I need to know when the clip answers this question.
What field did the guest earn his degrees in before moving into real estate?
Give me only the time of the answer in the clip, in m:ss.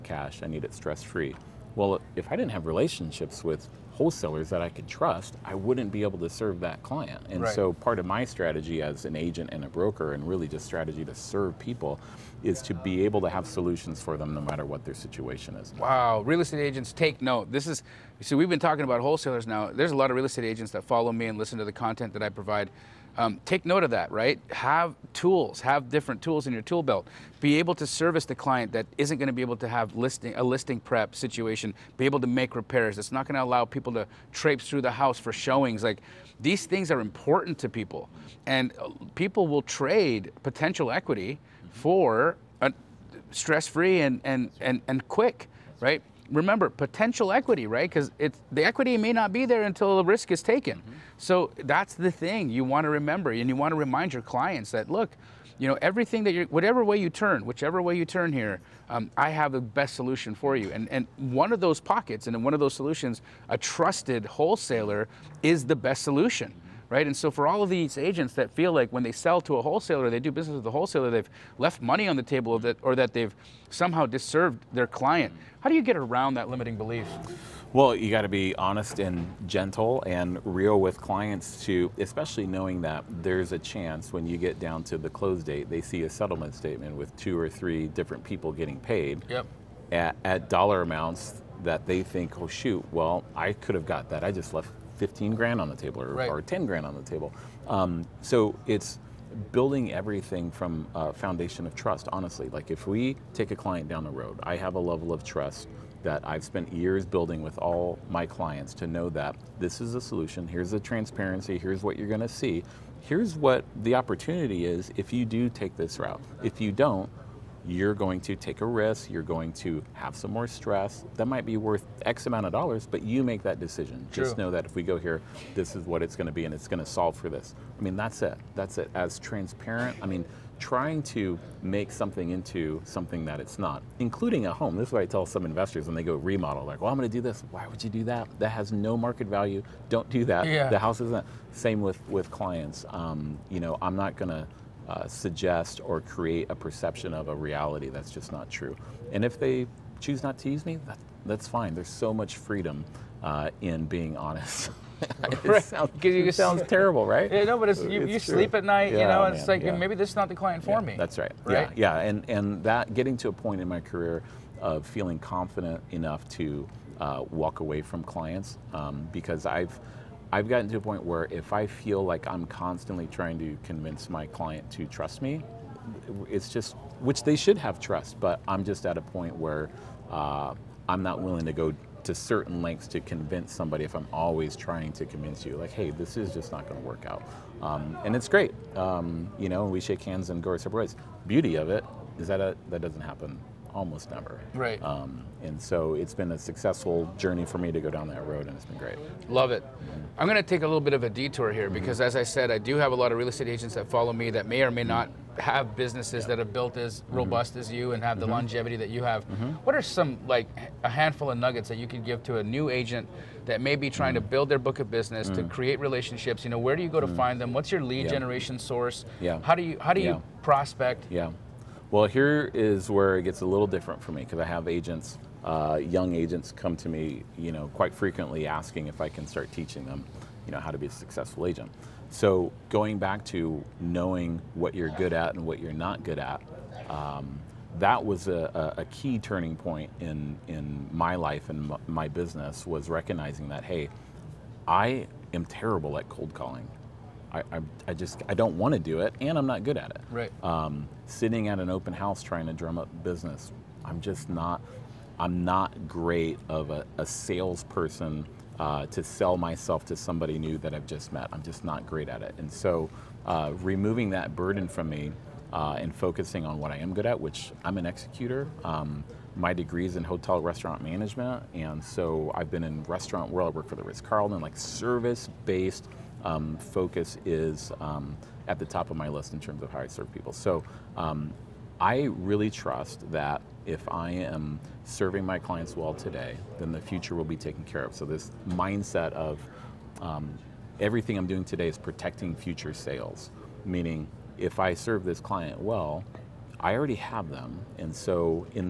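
4:30.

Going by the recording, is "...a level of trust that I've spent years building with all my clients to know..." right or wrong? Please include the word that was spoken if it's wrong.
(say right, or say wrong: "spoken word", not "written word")
right.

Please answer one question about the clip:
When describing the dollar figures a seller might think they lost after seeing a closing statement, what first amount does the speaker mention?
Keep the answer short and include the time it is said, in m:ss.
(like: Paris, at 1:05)
15 grand, at 1:35.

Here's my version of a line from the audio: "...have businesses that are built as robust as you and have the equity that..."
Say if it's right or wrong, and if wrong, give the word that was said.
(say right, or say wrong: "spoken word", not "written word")
wrong: "longevity", not "equity".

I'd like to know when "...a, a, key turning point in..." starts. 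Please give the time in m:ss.
3:58.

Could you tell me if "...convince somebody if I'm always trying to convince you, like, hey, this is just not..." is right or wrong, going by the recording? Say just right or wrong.
right.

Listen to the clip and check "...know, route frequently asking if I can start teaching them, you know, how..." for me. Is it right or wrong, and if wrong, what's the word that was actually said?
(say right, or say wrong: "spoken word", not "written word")
wrong: "quite", not "route".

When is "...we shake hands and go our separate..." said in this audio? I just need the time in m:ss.
3:09.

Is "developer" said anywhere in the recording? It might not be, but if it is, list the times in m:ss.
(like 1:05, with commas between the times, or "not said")
not said.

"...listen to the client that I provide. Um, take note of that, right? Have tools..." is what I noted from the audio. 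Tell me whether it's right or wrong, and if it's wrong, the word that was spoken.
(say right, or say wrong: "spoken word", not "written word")
wrong: "content", not "client".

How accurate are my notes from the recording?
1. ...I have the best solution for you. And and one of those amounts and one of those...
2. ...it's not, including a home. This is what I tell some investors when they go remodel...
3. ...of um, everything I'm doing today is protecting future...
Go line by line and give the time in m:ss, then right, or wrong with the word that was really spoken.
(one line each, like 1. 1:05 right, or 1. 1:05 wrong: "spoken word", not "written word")
1. 0:59 wrong: "pockets", not "amounts"
2. 2:13 right
3. 4:49 right.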